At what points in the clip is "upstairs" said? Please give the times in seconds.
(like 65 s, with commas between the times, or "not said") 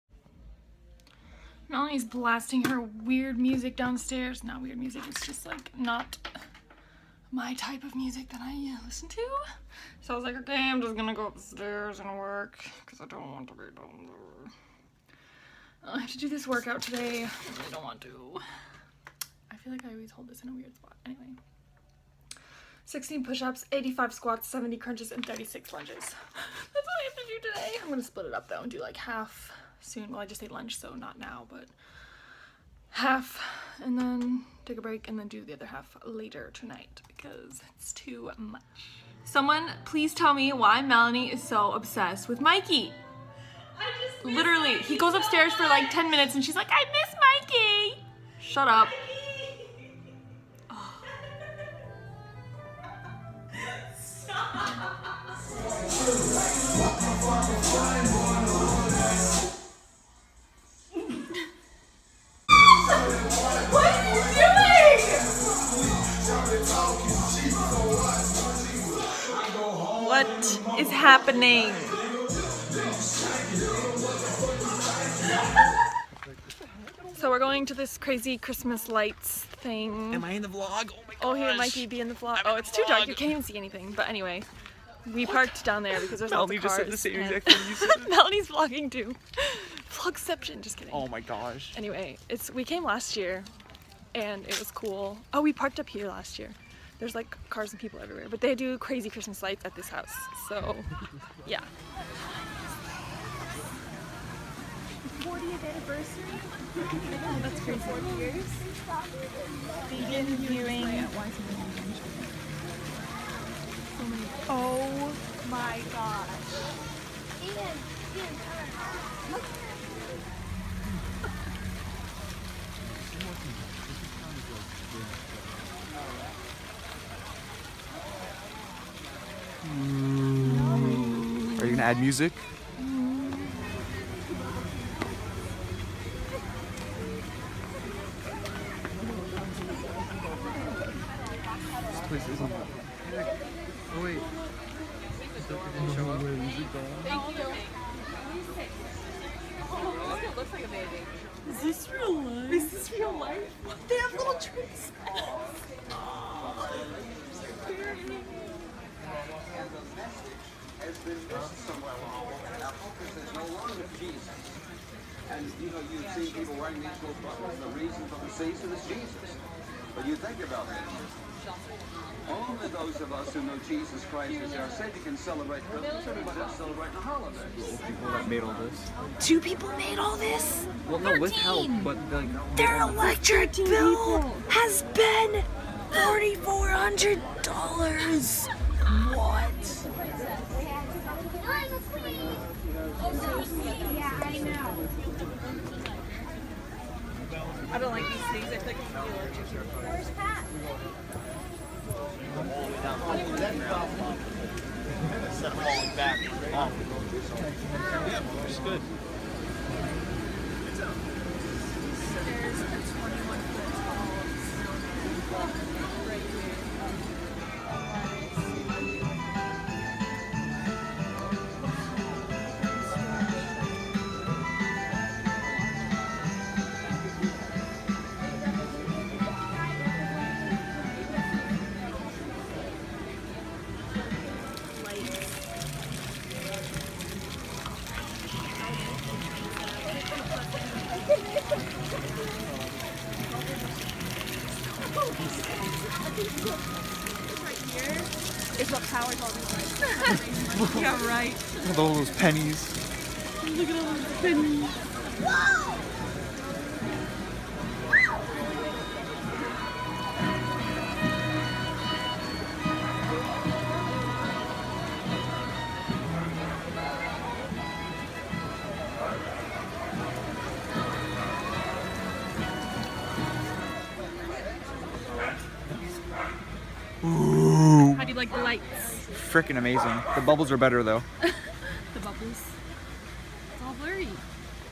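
11 s, 45 s.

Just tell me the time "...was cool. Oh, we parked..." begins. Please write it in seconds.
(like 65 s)
94 s.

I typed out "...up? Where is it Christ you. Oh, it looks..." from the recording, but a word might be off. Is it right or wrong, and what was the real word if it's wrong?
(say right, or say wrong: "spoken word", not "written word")
wrong: "Thank", not "Christ".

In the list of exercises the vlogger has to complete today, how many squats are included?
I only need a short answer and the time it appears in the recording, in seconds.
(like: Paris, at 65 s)
85, at 23 s.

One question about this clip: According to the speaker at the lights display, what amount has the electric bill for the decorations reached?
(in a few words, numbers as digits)
$4,400.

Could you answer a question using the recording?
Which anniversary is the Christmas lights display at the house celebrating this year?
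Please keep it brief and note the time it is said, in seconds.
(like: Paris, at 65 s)
40th, at 105 s.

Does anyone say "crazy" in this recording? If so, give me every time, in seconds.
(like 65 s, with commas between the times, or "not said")
77 s, 98 s, 107 s.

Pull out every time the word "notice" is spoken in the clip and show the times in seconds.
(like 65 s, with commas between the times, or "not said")
not said.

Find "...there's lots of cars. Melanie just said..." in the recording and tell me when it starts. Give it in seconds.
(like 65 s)
86 s.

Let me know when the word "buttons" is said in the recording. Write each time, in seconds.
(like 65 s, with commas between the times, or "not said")
167 s.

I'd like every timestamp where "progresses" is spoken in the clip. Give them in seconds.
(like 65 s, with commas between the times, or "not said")
not said.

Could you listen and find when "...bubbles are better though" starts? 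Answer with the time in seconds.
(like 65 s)
280 s.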